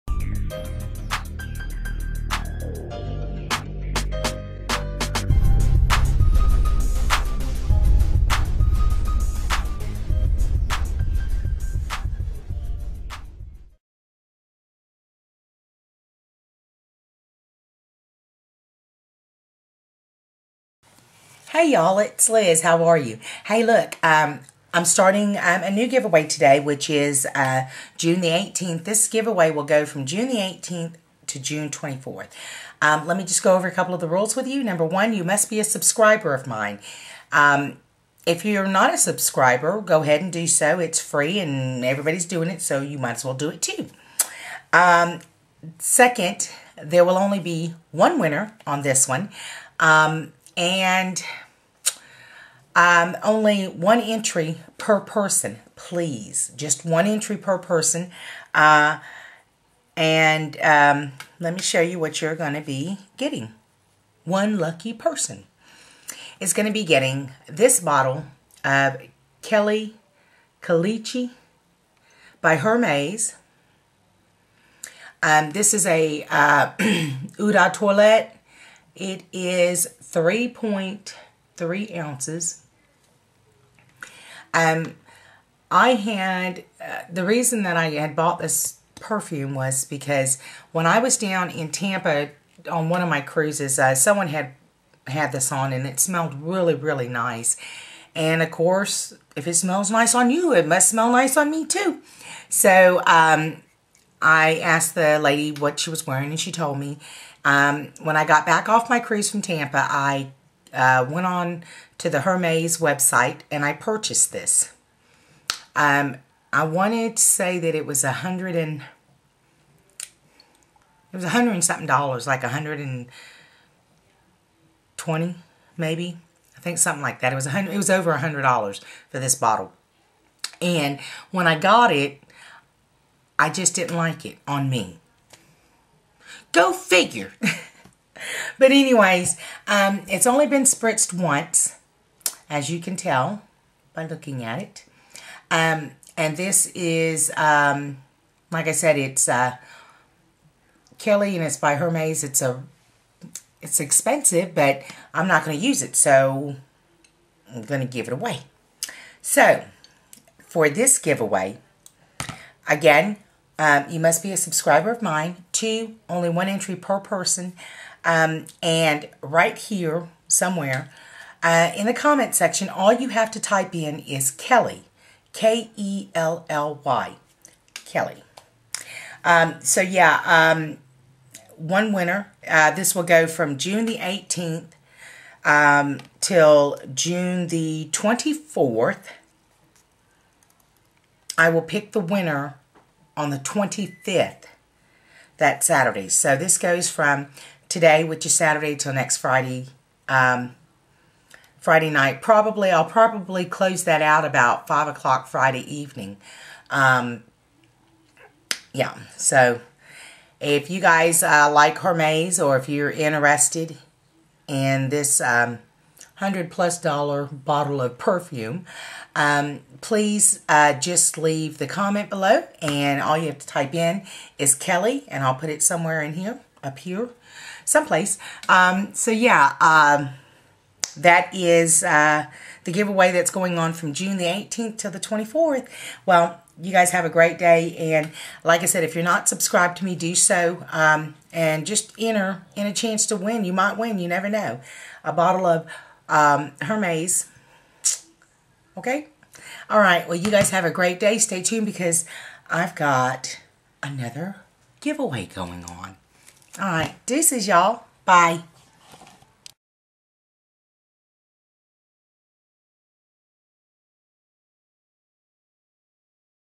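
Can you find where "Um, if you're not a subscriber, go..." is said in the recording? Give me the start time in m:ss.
0:37.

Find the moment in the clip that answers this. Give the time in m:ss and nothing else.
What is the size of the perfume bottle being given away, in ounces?
1:20.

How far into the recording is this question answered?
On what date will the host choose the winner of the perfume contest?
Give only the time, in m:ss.
3:13.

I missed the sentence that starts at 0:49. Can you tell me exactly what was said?
Um, and um, only one entry per person, please.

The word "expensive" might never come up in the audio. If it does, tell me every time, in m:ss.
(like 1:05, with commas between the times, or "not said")
2:33.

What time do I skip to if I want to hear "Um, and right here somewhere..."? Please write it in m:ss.
2:48.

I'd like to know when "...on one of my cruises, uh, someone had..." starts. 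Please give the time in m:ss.
1:32.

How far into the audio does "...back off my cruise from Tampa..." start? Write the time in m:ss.
1:48.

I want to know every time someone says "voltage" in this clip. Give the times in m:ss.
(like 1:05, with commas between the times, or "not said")
not said.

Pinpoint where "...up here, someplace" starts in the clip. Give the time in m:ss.
3:46.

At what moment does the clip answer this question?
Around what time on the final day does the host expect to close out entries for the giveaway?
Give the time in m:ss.
3:24.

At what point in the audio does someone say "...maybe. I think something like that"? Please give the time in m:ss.
2:05.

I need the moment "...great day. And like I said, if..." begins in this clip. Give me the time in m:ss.
3:57.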